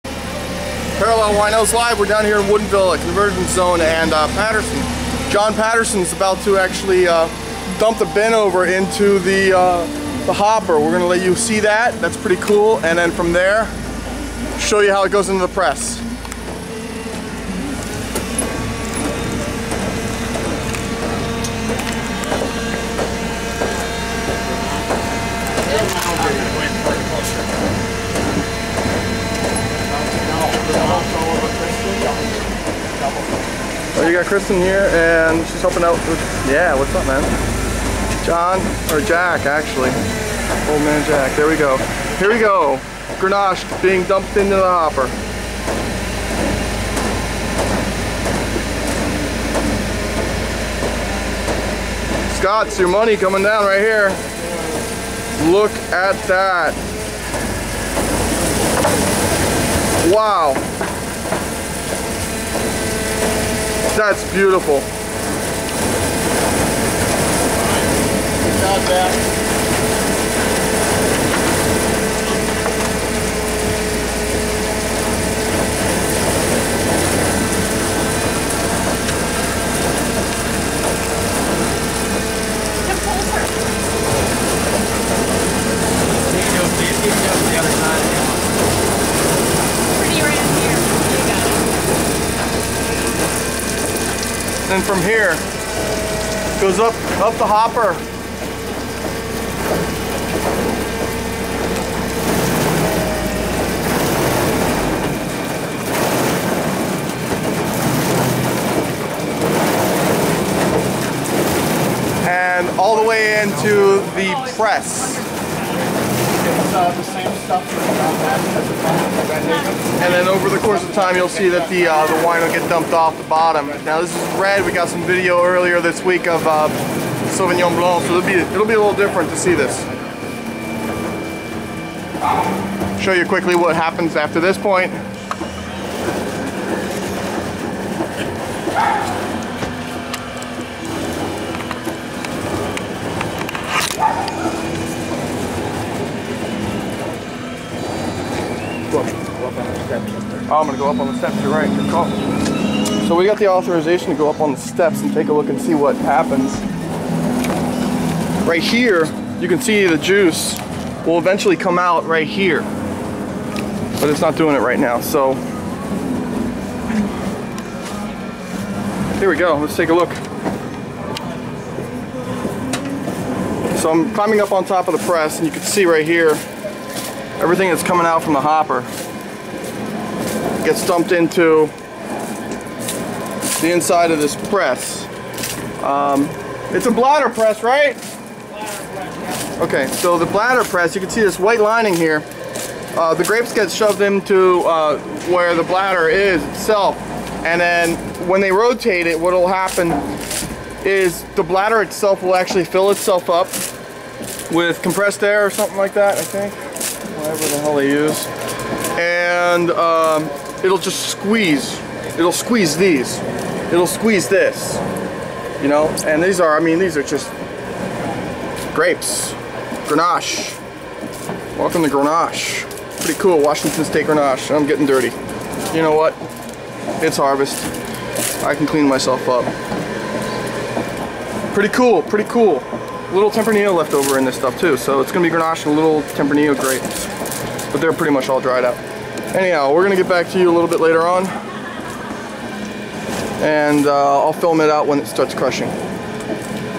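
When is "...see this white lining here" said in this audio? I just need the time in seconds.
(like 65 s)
191 s.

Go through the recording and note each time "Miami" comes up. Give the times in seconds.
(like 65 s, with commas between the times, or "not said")
not said.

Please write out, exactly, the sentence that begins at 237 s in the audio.
But they're pretty much all dried out.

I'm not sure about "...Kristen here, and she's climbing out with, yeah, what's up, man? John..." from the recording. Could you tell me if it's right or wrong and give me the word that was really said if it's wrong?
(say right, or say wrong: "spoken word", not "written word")
wrong: "helping", not "climbing".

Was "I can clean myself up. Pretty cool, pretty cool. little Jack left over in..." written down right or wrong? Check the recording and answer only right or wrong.
wrong.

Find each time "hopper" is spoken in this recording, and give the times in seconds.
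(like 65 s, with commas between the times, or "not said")
10 s, 44 s, 97 s, 178 s.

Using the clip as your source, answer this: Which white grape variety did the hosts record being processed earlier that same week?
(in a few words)
Sauvignon Blanc.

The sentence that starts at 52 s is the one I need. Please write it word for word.
Scott's your money coming down right here.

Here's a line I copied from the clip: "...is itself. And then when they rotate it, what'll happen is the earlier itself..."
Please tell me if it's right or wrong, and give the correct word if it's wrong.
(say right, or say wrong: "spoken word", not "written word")
wrong: "bladder", not "earlier".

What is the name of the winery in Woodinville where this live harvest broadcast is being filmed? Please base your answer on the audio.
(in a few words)
Convergence Zone.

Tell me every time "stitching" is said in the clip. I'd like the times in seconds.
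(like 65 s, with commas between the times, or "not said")
not said.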